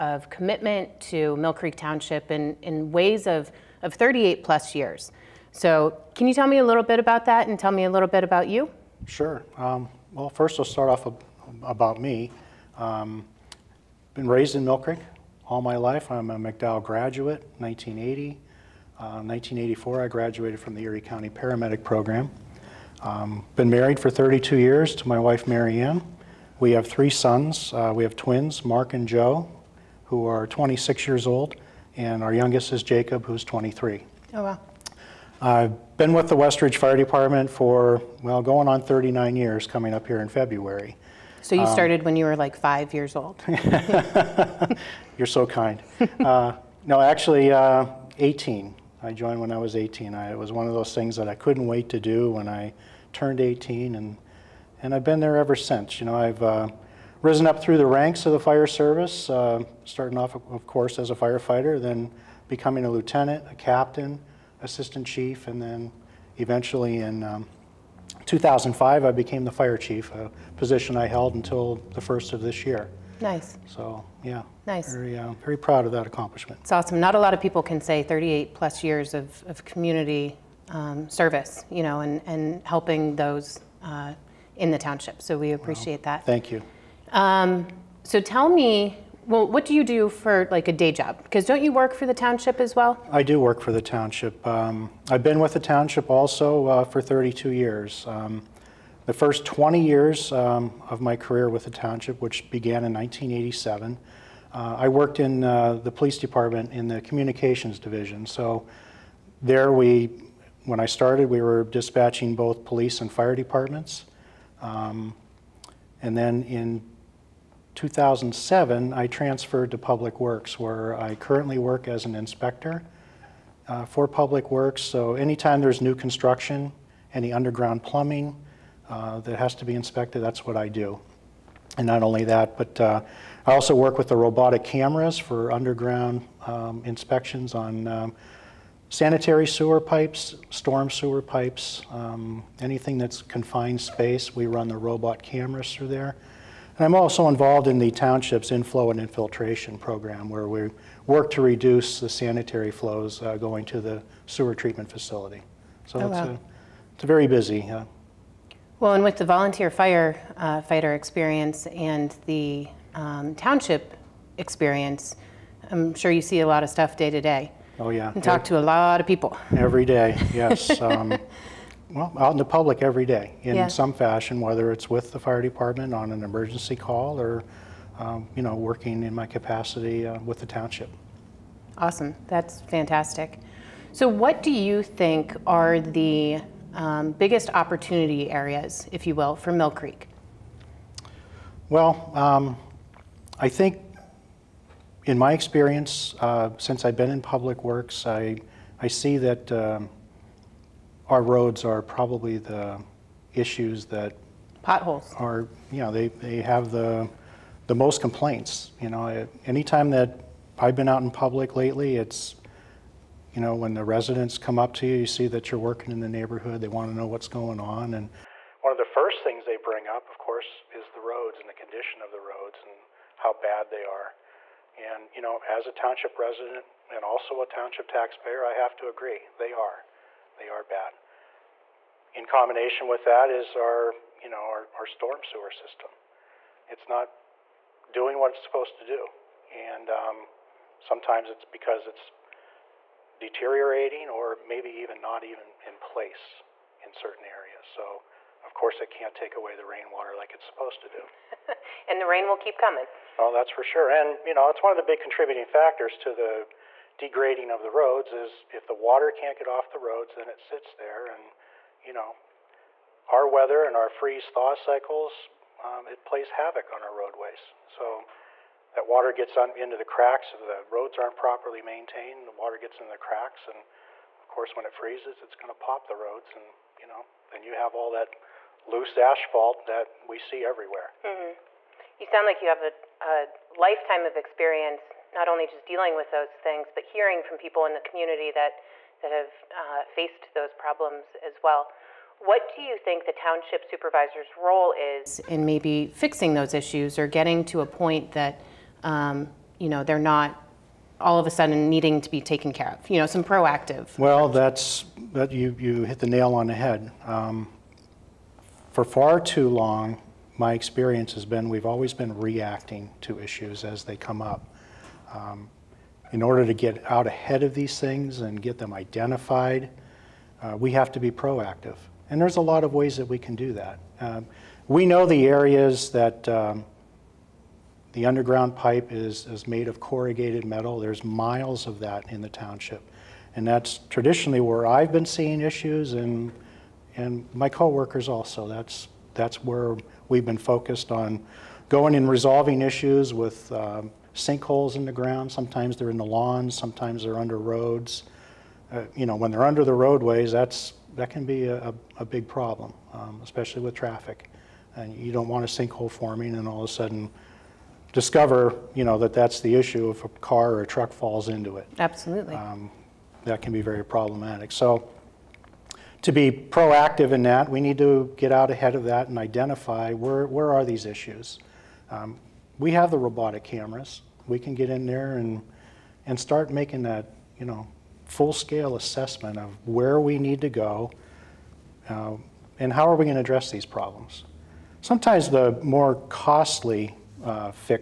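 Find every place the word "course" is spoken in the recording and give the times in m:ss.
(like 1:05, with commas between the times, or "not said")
1:00, 3:40, 4:08, 4:34.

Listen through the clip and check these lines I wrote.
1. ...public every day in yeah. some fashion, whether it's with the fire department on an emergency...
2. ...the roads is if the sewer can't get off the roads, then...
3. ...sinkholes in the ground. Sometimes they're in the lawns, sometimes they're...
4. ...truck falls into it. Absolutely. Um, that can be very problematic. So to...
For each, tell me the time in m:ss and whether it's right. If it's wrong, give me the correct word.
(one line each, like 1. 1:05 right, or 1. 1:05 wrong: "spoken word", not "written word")
1. 2:52 right
2. 4:17 wrong: "water", not "sewer"
3. 5:44 right
4. 6:00 right.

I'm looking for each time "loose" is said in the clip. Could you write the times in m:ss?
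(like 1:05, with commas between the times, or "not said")
4:38.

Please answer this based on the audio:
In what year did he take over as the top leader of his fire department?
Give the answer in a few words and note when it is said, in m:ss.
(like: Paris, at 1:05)
2005, at 1:08.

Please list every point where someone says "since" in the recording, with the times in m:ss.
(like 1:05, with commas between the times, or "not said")
0:55, 3:16.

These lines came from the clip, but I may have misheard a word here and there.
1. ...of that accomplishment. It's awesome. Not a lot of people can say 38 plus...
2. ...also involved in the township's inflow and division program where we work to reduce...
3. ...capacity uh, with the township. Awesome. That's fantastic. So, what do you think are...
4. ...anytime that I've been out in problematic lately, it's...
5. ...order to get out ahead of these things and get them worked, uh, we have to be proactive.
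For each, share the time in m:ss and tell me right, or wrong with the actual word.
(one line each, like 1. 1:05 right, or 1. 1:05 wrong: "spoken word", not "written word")
1. 1:15 right
2. 2:26 wrong: "infiltration", not "division"
3. 2:59 right
4. 3:29 wrong: "public", not "problematic"
5. 5:16 wrong: "identified", not "worked".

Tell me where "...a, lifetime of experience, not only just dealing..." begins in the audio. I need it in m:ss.
4:43.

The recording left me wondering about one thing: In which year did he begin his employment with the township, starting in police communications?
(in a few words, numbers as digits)
1987.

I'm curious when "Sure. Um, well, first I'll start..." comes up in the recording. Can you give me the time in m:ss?
0:09.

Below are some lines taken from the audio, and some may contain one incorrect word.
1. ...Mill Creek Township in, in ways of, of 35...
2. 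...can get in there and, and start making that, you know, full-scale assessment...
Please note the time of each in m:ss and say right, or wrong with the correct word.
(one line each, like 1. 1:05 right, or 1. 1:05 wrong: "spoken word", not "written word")
1. 0:01 wrong: "38", not "35"
2. 6:14 right.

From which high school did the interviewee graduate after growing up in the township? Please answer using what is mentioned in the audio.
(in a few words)
McDowell.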